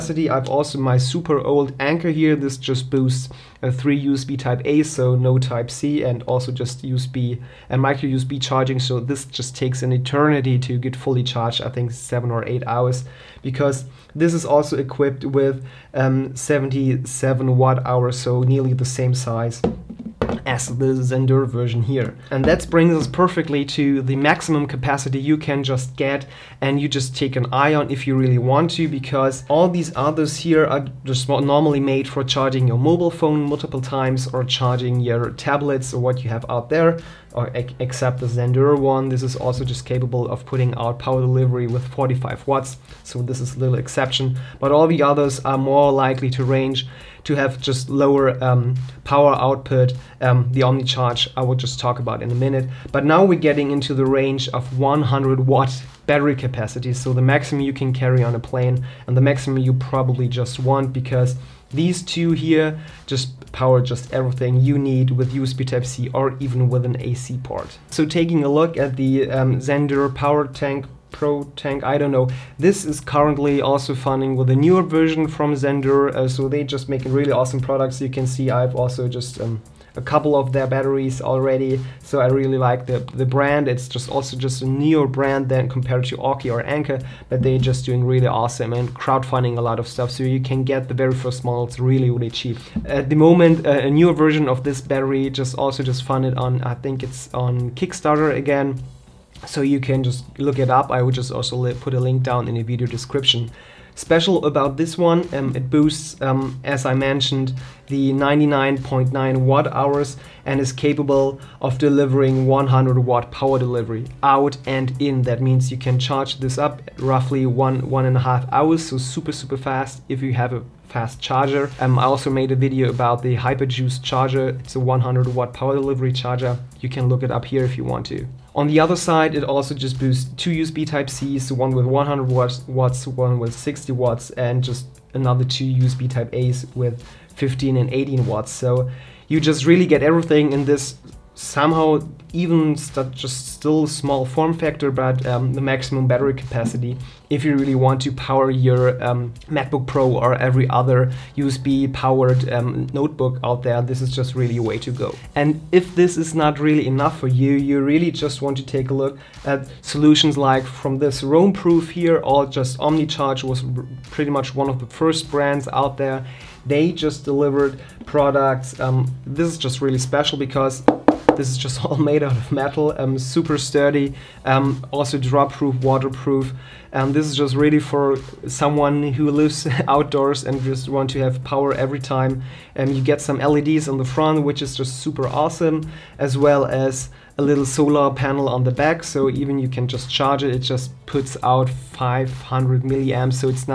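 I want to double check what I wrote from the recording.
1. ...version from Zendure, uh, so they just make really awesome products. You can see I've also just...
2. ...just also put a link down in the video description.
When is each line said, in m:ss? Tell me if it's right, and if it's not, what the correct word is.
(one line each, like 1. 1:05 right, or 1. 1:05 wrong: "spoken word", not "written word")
1. 1:14 right
2. 1:41 right.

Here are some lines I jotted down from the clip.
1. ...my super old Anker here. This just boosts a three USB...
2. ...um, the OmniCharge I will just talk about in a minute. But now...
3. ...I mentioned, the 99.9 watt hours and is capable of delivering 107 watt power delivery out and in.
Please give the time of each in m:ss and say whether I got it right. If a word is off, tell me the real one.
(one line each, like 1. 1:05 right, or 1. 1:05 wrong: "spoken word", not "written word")
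1. 0:00 right
2. 0:50 right
3. 1:46 wrong: "100", not "107".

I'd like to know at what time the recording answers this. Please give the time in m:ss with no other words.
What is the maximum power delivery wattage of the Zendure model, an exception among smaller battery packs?
0:41.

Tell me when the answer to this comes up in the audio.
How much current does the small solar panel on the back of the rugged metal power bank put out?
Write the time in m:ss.
3:11.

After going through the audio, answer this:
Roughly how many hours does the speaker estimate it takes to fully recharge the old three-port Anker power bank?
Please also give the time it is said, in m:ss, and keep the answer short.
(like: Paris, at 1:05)
7 or 8 hours, at 0:11.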